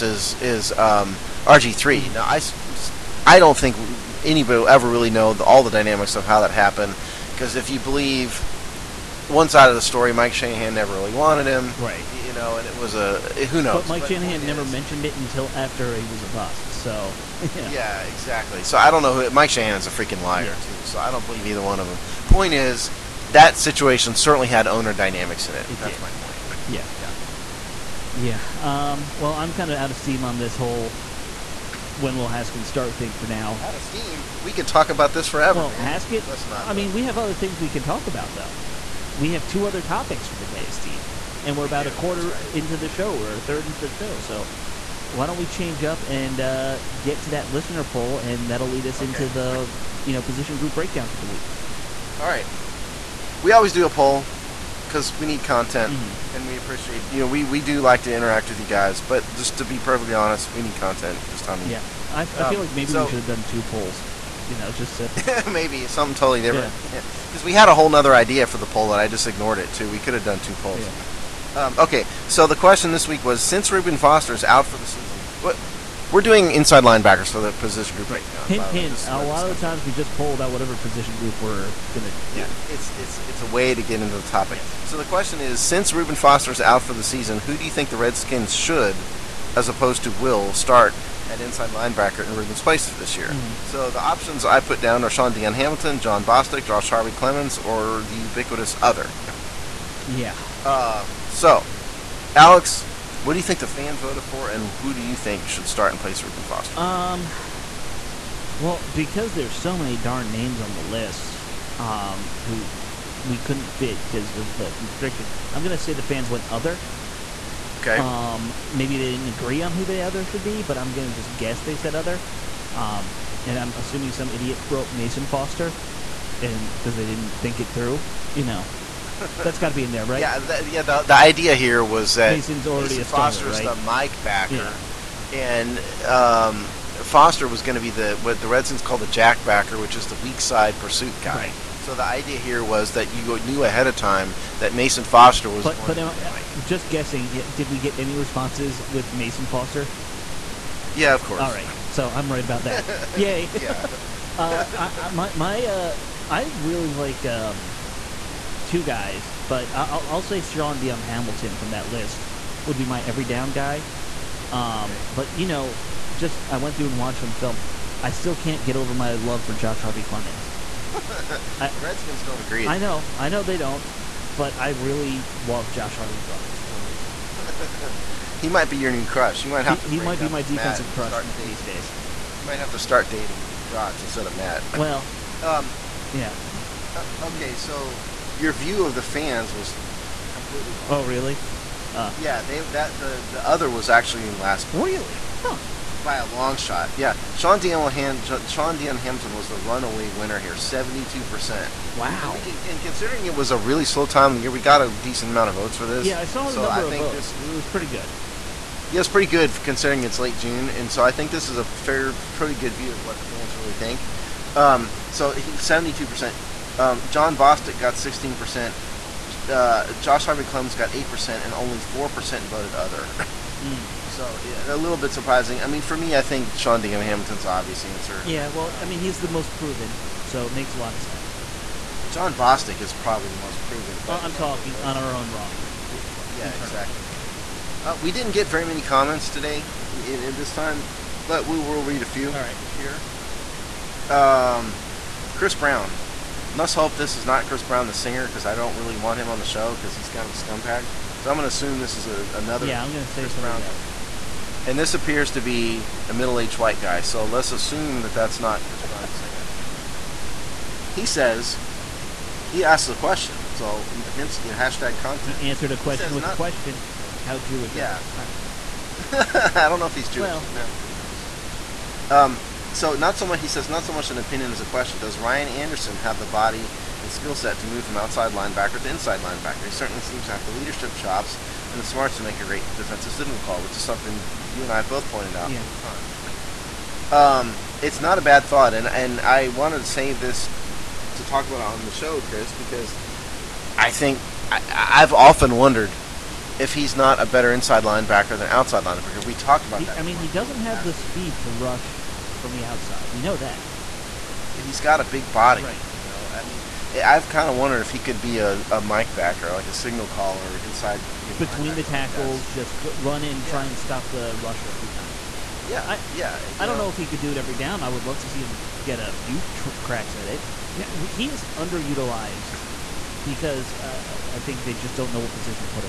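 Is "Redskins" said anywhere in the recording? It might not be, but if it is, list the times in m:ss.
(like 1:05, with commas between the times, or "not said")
1:27, 2:18, 2:51.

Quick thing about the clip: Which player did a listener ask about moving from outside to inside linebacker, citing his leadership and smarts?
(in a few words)
Ryan Anderson.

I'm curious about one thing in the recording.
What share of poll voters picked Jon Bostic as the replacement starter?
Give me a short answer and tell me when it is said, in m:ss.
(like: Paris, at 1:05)
16%, at 3:38.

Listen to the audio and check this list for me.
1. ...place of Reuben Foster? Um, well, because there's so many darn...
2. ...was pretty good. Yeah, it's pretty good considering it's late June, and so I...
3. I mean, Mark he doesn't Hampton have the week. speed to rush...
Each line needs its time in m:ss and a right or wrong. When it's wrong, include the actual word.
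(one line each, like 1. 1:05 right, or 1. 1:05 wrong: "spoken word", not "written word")
1. 1:45 right
2. 3:27 right
3. 4:59 wrong: "Boyd", not "Hampton".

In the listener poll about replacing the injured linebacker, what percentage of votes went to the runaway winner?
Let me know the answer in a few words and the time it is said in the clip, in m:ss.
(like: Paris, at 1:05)
72%, at 3:20.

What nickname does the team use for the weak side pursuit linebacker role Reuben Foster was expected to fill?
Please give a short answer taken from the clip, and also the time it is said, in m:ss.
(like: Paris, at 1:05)
jack backer, at 2:19.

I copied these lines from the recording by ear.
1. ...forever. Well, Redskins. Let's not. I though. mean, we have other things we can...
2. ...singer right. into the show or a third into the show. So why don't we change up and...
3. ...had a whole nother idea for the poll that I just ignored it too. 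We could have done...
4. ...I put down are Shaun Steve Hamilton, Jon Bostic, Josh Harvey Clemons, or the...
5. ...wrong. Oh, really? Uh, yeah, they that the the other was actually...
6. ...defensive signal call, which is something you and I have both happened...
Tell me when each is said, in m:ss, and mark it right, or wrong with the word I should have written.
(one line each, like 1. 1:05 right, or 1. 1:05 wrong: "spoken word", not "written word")
1. 0:35 wrong: "Haskins", not "Redskins"
2. 0:41 wrong: "quarter", not "singer"
3. 1:07 right
4. 1:34 wrong: "Dion", not "Steve"
5. 3:10 right
6. 4:42 wrong: "pointed", not "happened".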